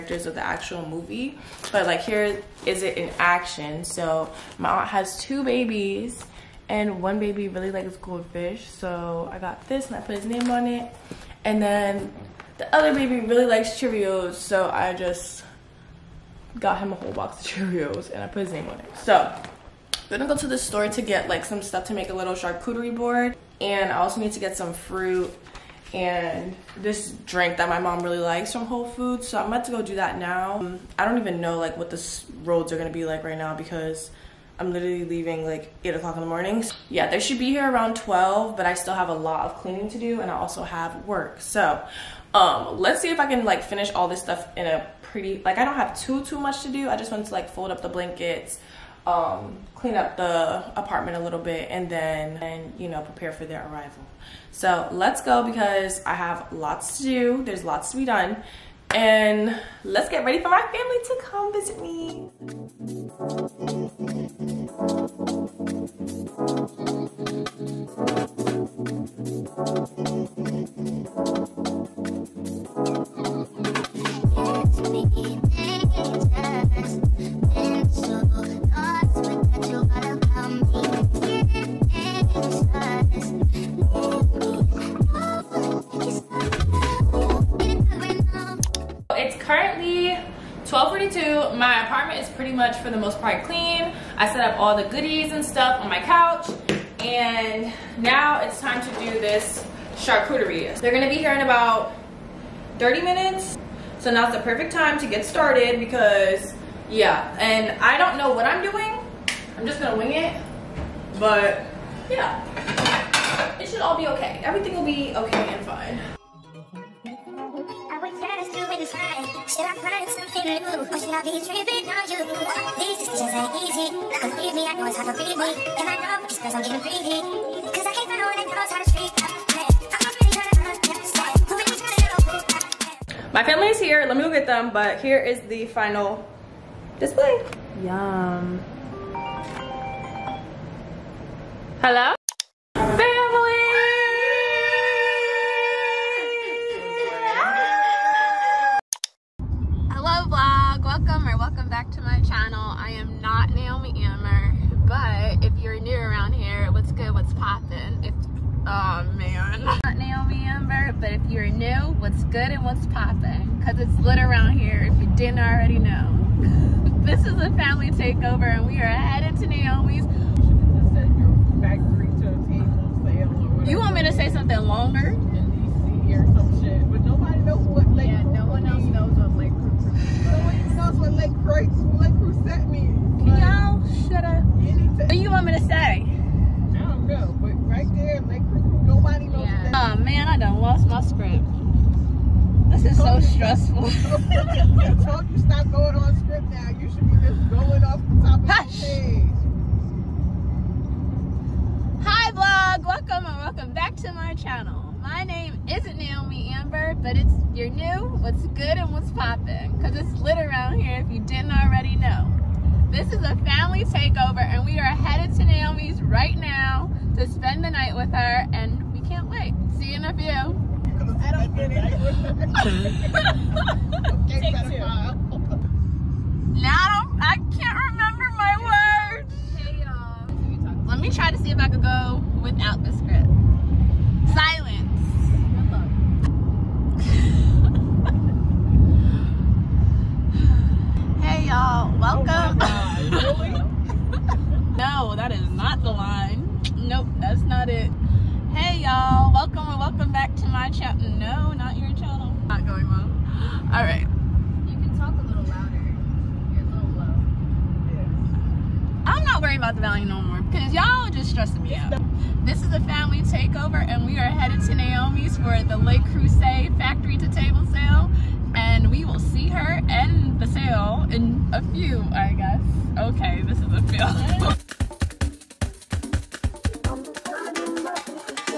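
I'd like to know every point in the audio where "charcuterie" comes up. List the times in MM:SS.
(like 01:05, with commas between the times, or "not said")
00:22, 01:39.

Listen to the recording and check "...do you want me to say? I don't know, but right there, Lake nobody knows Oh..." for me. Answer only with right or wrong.
right.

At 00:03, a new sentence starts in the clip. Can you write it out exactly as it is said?
So my aunt has two babies and one baby really likes goldfish.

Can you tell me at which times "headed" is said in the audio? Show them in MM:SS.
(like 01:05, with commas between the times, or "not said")
02:48, 03:34.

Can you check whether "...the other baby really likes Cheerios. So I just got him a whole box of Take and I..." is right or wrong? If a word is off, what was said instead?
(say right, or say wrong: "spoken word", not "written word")
wrong: "Cheerios", not "Take".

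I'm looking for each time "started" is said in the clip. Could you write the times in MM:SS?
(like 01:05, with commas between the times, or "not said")
01:45.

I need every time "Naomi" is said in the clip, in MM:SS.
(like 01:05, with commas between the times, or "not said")
02:49, 03:25, 03:35.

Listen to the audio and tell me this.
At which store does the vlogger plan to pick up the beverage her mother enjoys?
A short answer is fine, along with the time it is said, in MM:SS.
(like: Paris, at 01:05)
Whole Foods, at 00:28.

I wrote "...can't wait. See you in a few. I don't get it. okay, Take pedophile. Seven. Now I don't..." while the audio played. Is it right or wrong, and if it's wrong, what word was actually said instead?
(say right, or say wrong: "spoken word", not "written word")
wrong: "Two", not "Seven".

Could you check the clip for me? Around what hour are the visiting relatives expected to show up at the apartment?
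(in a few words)
12.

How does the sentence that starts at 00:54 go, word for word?
So let's go because I have lots to do.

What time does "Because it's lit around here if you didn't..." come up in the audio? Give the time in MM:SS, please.
03:29.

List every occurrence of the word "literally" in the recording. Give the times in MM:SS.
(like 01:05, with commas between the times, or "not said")
00:34.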